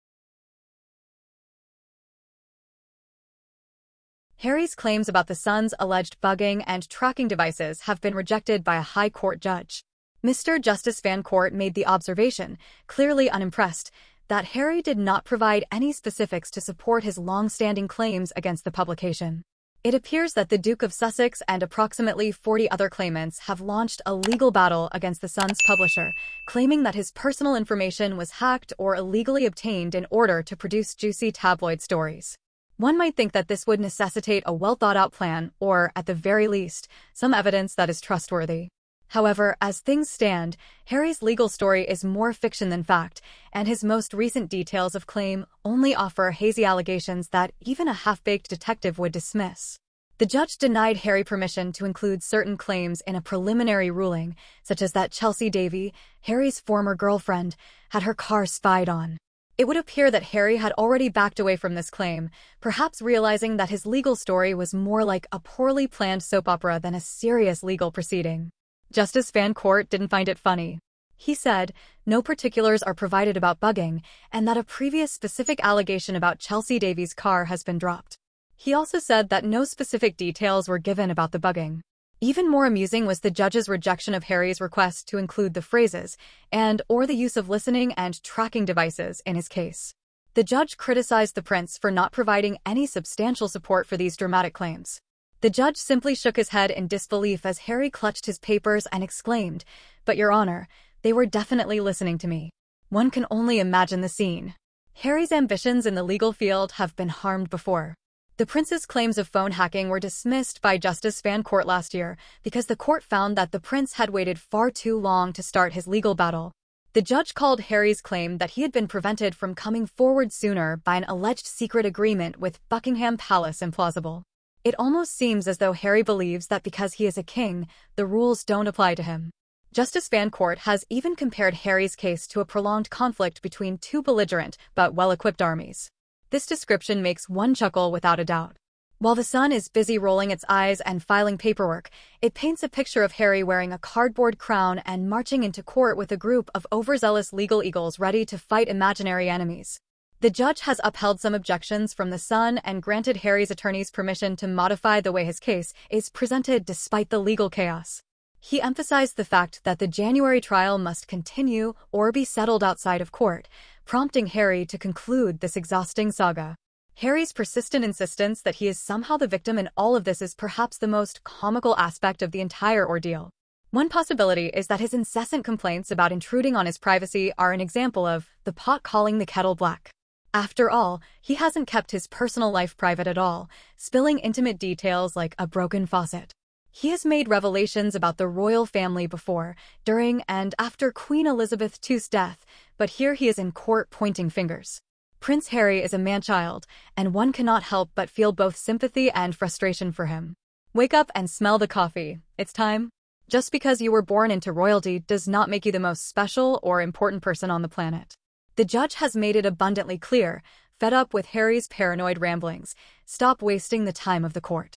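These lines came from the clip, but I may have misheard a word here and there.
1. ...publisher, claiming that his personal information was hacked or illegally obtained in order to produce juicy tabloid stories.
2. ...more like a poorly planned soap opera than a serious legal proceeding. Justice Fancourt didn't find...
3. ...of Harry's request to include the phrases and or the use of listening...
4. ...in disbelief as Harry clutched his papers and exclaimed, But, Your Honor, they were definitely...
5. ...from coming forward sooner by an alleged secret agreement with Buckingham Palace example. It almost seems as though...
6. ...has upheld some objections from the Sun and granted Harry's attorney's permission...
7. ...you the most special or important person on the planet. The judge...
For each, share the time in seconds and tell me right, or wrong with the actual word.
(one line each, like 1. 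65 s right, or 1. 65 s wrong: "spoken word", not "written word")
1. 25 s right
2. 64 s right
3. 84 s right
4. 96 s right
5. 119 s wrong: "implausible", not "example"
6. 150 s right
7. 205 s right.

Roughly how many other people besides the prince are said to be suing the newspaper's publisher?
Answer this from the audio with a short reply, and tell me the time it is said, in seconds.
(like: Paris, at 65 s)
40, at 21 s.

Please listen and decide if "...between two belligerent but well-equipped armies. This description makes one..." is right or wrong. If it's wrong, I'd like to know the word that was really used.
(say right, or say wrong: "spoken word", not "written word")
right.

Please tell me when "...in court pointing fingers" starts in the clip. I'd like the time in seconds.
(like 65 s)
193 s.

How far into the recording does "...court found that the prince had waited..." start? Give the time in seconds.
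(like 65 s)
112 s.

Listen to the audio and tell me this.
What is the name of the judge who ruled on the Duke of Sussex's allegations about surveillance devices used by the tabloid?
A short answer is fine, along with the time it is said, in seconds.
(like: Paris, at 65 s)
Mr. Justice Fancourt, at 10 s.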